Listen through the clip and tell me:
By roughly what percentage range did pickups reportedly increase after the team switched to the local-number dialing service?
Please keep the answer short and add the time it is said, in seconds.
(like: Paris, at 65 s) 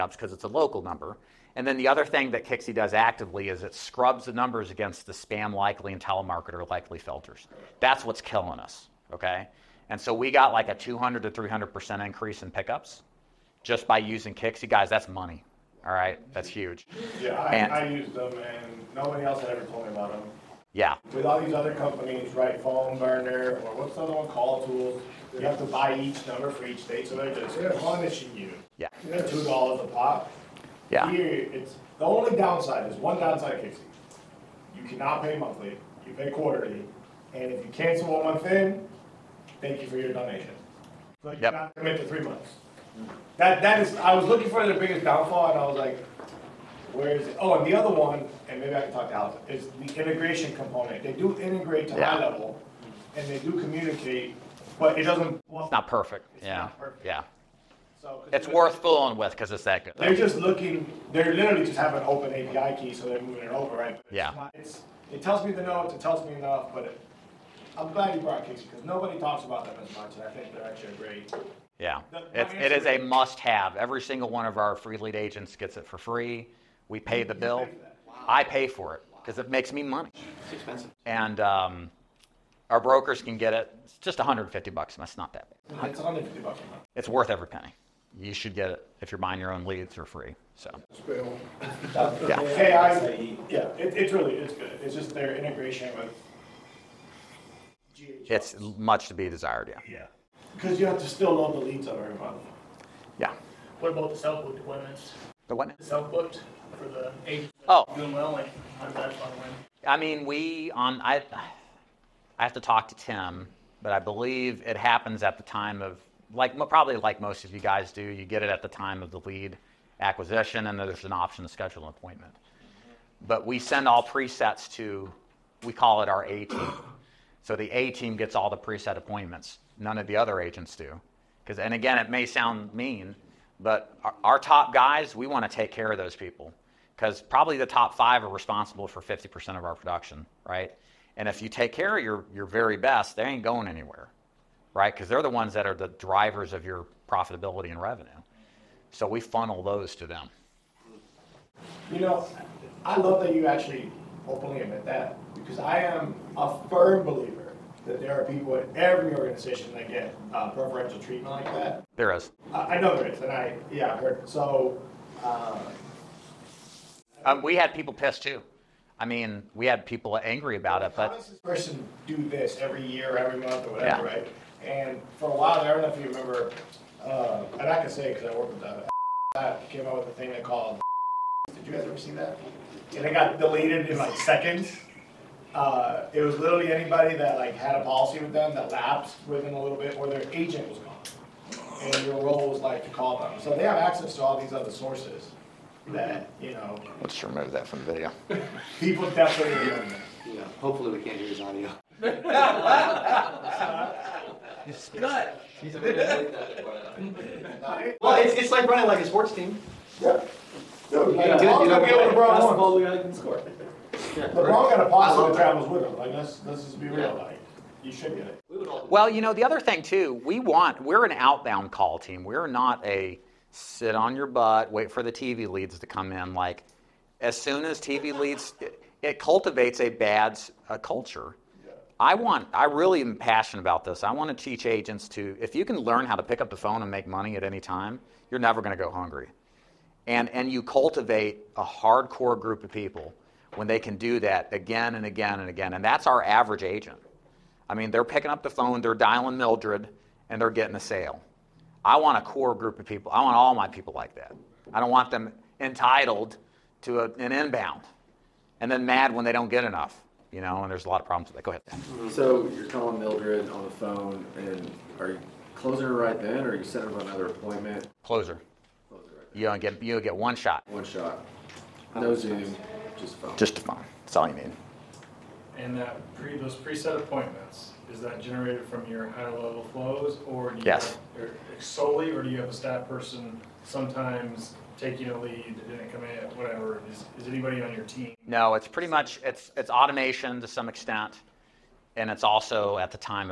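200 to 300%, at 10 s.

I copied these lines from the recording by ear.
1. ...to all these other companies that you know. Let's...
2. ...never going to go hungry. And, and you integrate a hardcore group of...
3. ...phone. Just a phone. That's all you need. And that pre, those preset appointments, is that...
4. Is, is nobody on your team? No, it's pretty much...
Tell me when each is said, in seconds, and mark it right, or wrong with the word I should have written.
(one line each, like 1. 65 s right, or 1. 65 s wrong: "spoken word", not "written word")
1. 194 s wrong: "sources", not "companies"
2. 238 s wrong: "cultivate", not "integrate"
3. 273 s right
4. 286 s wrong: "anybody", not "nobody".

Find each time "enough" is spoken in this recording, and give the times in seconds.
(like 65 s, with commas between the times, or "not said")
66 s, 259 s.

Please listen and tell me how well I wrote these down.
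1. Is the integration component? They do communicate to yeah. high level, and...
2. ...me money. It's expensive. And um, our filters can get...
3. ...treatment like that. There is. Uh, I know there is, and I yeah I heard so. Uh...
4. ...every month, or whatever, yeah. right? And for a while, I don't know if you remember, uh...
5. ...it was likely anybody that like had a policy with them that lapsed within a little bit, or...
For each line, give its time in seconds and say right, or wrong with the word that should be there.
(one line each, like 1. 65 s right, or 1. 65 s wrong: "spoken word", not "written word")
1. 49 s wrong: "integrate", not "communicate"
2. 79 s wrong: "brokers", not "filters"
3. 160 s right
4. 173 s right
5. 186 s wrong: "literally", not "likely".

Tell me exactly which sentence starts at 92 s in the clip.
Hey, I, yeah, it, it's really it's good.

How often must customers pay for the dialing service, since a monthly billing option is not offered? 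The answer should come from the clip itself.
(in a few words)
Quarterly.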